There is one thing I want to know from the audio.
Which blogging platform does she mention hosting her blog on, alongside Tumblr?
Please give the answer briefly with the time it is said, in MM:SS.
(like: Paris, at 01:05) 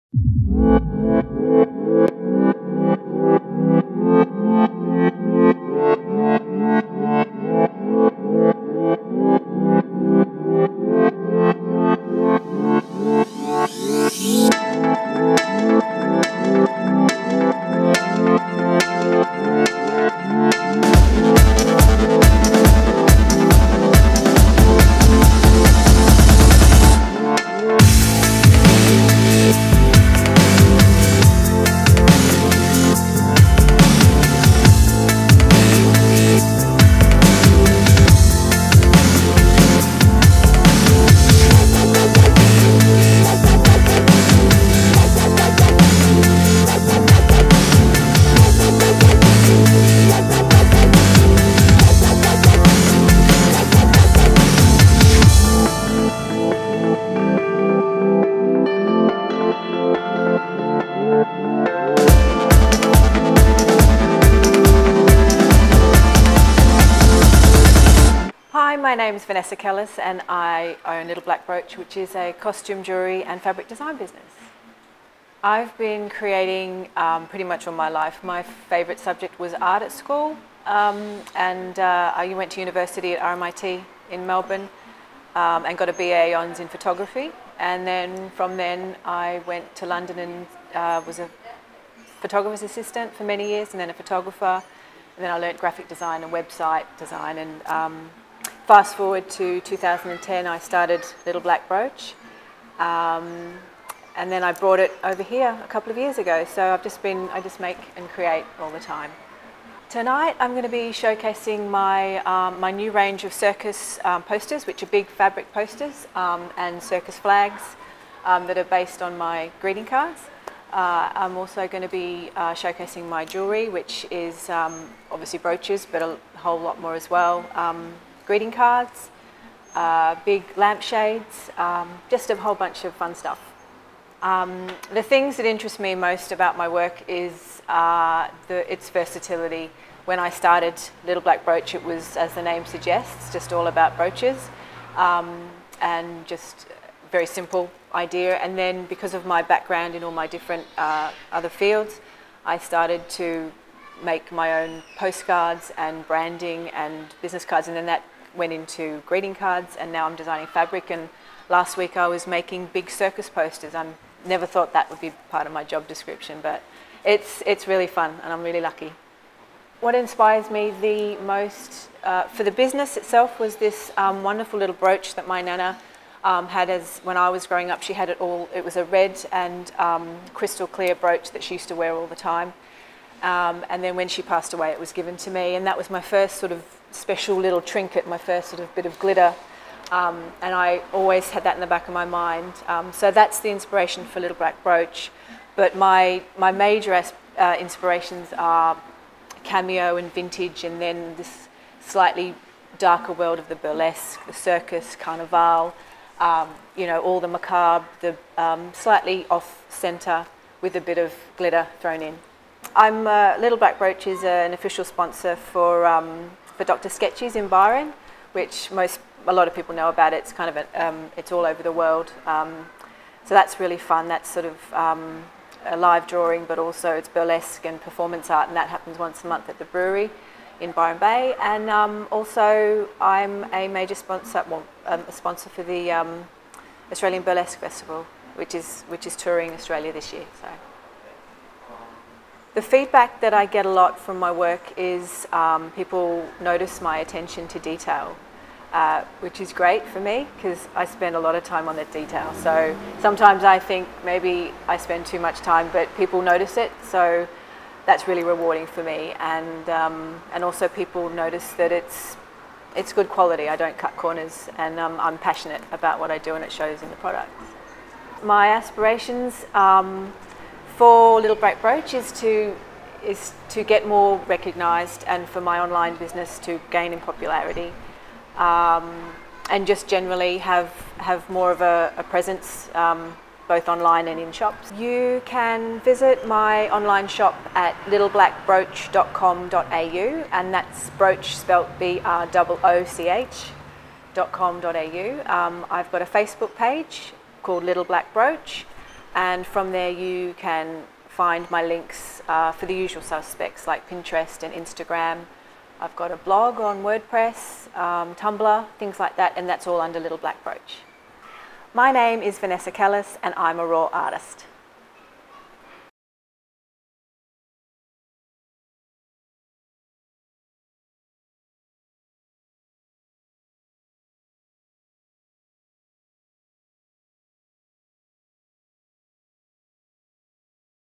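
WordPress, at 05:06.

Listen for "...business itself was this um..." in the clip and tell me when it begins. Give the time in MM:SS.
02:52.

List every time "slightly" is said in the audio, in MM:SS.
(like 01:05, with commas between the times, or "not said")
03:21, 03:28.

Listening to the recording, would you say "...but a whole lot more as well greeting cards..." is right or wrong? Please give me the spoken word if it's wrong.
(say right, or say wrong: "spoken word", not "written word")
right.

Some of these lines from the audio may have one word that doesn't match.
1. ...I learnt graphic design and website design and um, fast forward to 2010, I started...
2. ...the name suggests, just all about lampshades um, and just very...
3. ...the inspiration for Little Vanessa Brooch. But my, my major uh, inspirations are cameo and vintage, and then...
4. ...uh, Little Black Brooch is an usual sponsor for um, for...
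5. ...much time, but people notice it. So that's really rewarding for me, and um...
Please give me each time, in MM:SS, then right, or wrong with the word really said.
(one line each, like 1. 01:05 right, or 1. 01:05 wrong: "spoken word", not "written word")
1. 01:35 right
2. 02:22 wrong: "brooches", not "lampshades"
3. 03:13 wrong: "Black", not "Vanessa"
4. 03:33 wrong: "official", not "usual"
5. 04:15 right.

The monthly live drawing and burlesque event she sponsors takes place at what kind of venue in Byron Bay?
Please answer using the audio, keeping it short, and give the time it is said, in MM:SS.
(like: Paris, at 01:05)
The brewery, at 03:49.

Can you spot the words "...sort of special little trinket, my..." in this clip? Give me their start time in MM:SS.
03:06.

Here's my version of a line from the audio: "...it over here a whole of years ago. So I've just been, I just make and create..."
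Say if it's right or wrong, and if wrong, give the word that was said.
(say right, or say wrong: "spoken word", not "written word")
wrong: "couple", not "whole".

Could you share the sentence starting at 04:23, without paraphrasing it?
I don't cut corners, and um, I'm passionate about what I do, and it shows in the products.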